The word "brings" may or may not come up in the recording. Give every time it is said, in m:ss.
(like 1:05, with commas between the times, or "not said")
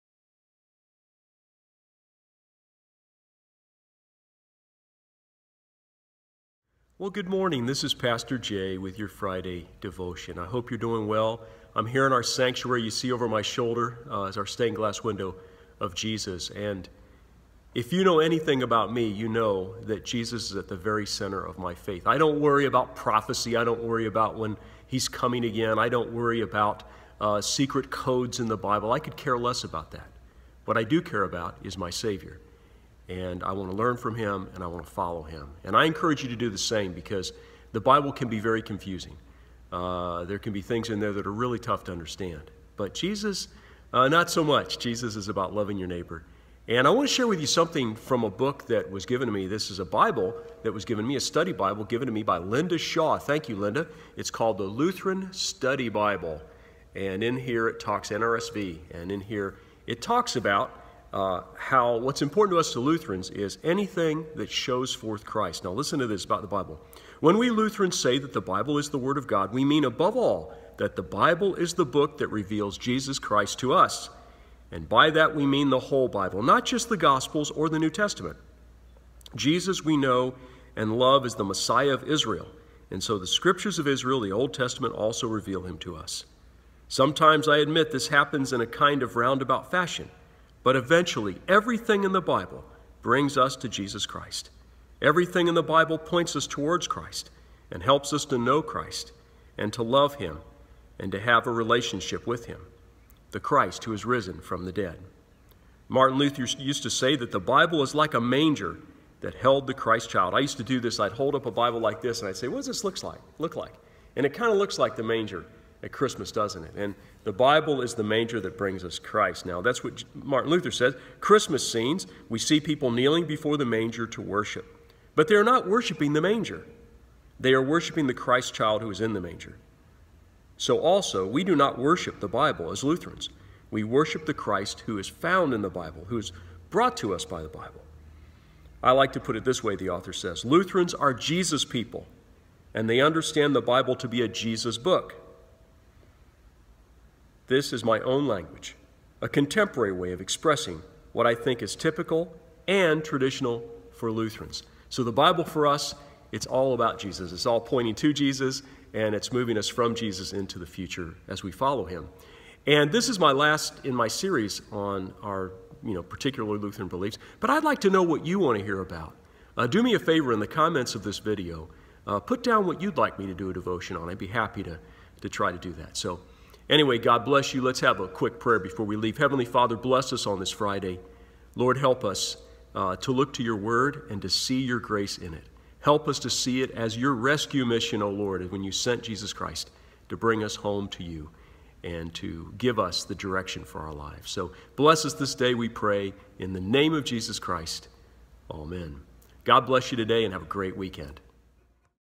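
1:33, 1:58, 3:10.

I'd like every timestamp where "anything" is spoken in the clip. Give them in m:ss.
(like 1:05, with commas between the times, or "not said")
0:18, 1:03.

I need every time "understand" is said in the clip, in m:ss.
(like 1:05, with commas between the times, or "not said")
0:41, 2:23.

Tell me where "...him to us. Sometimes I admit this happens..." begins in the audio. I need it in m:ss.
1:25.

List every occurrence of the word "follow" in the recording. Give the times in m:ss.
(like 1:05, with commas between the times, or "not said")
0:34, 2:41.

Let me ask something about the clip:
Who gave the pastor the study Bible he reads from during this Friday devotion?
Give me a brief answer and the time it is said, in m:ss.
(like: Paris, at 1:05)
Linda Shaw, at 0:52.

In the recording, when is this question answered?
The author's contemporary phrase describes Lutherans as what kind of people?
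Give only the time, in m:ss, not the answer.
2:21.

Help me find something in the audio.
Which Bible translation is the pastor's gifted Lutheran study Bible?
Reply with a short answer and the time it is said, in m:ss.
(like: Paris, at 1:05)
NRSV, at 0:58.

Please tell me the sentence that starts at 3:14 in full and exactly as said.
So bless us this day, we pray, in the name of Jesus Christ.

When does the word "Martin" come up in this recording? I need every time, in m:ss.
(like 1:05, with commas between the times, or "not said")
1:45, 2:00.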